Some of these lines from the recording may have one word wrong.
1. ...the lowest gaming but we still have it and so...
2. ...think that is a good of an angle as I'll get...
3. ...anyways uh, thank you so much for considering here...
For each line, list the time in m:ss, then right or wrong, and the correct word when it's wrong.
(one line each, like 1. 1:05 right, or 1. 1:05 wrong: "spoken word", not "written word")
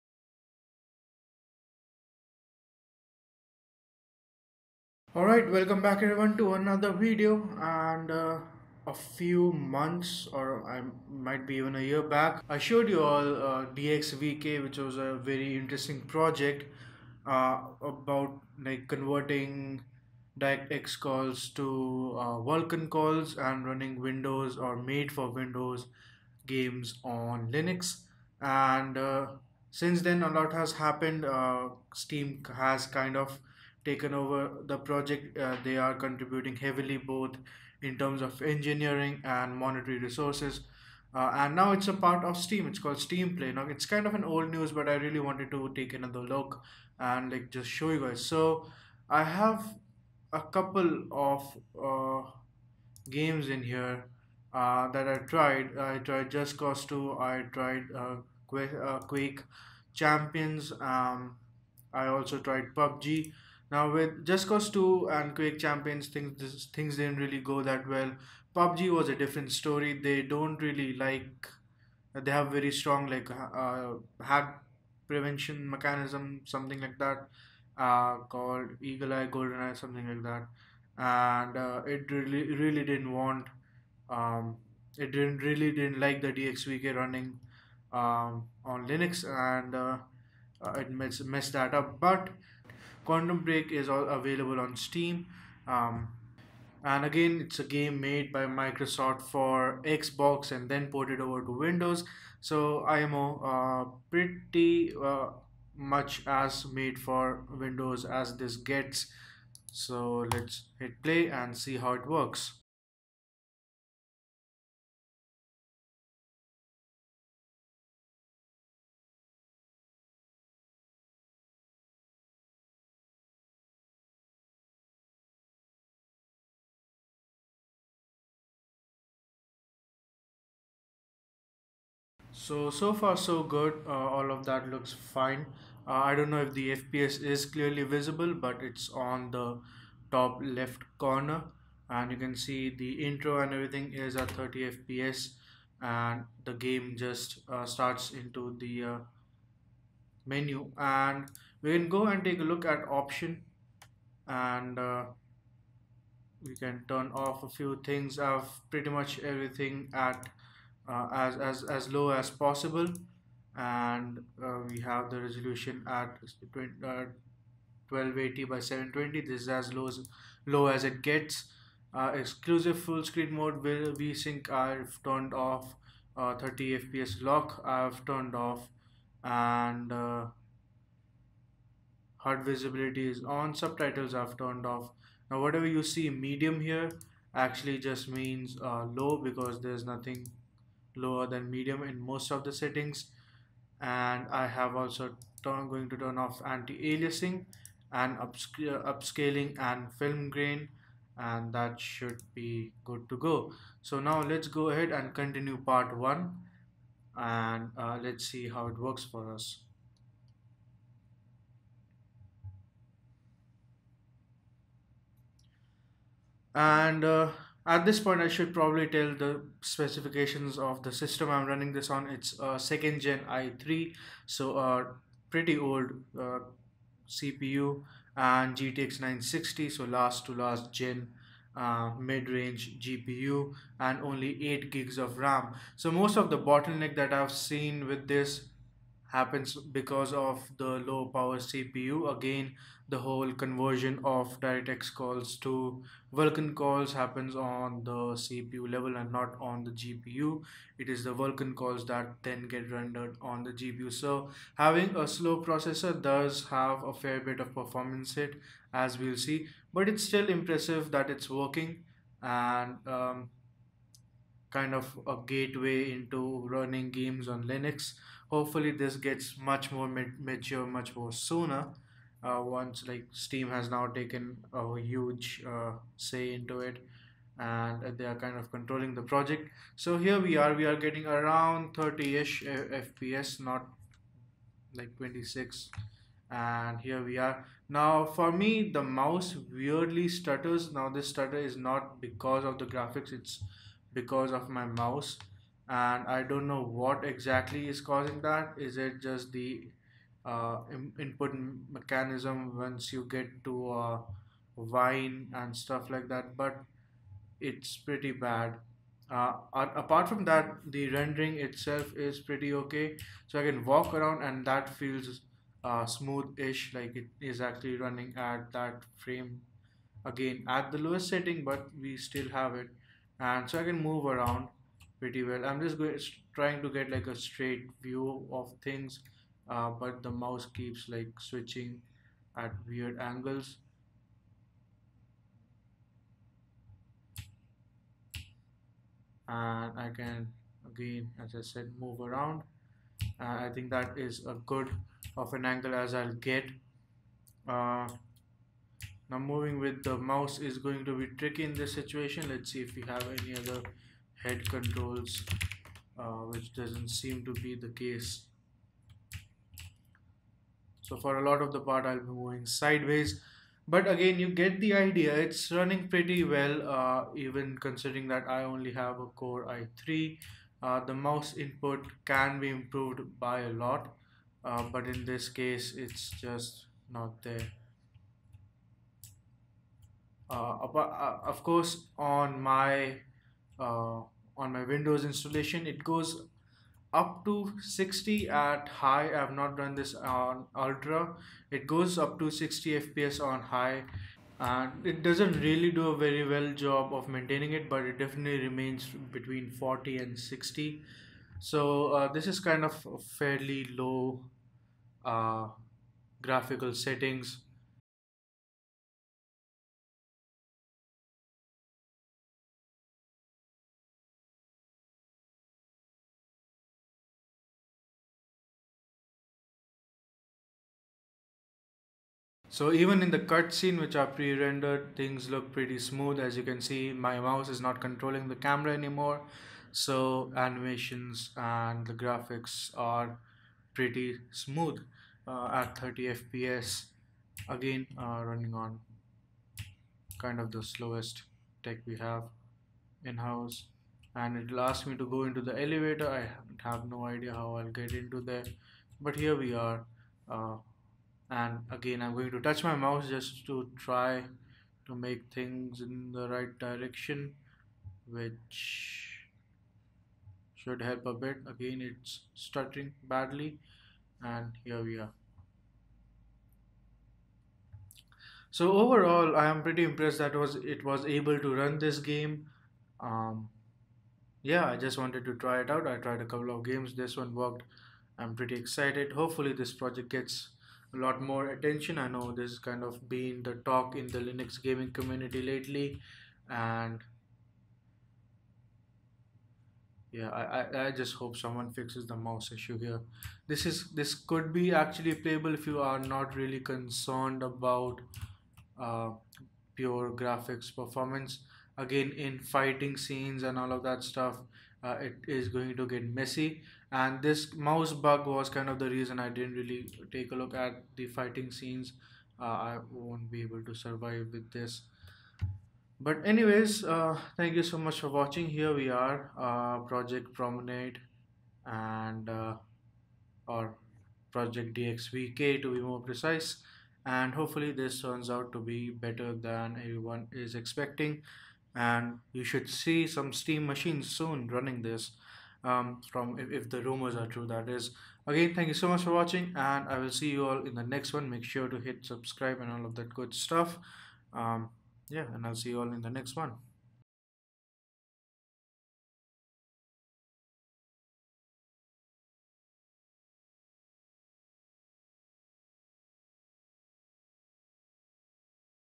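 1. 5:20 wrong: "setting", not "gaming"
2. 5:43 right
3. 8:36 wrong: "watching", not "considering".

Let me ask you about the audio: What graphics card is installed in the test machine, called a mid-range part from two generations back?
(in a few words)
GTX 960.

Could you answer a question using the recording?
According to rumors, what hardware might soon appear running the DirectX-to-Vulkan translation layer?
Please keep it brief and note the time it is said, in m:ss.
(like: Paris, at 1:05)
Steam machines, at 8:53.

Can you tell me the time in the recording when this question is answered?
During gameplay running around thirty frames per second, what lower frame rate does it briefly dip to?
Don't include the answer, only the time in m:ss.
4:44.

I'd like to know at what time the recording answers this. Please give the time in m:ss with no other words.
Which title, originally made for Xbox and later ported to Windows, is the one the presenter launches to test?
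1:33.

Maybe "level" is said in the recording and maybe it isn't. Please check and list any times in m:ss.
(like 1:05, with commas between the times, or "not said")
4:08.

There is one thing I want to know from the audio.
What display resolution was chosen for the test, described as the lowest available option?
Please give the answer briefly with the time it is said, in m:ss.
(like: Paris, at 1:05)
1280 by 720, at 2:46.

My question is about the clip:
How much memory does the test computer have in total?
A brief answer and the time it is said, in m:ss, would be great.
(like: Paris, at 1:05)
8 GB, at 3:54.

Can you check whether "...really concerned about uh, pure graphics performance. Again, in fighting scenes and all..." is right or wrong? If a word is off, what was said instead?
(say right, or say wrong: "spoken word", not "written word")
right.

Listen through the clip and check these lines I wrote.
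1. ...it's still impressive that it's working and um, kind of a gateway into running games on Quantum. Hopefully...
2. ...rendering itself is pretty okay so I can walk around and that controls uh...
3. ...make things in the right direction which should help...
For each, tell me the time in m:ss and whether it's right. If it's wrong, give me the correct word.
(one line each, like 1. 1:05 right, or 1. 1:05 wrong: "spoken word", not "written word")
1. 4:19 wrong: "Linux", not "Quantum"
2. 5:10 wrong: "feels", not "controls"
3. 7:34 right.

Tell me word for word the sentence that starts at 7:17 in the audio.
Again, uh, running on kind of the slowest tech we have in-house.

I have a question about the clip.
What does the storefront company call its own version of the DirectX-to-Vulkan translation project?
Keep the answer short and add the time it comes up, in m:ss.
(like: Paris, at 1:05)
Steam Play, at 0:42.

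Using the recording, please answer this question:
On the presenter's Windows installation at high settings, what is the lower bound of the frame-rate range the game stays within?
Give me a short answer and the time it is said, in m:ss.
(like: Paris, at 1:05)
40, at 6:39.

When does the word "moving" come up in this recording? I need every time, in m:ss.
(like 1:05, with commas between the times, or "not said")
5:49, 6:02.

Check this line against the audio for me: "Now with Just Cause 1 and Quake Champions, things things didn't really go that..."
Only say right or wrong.
wrong.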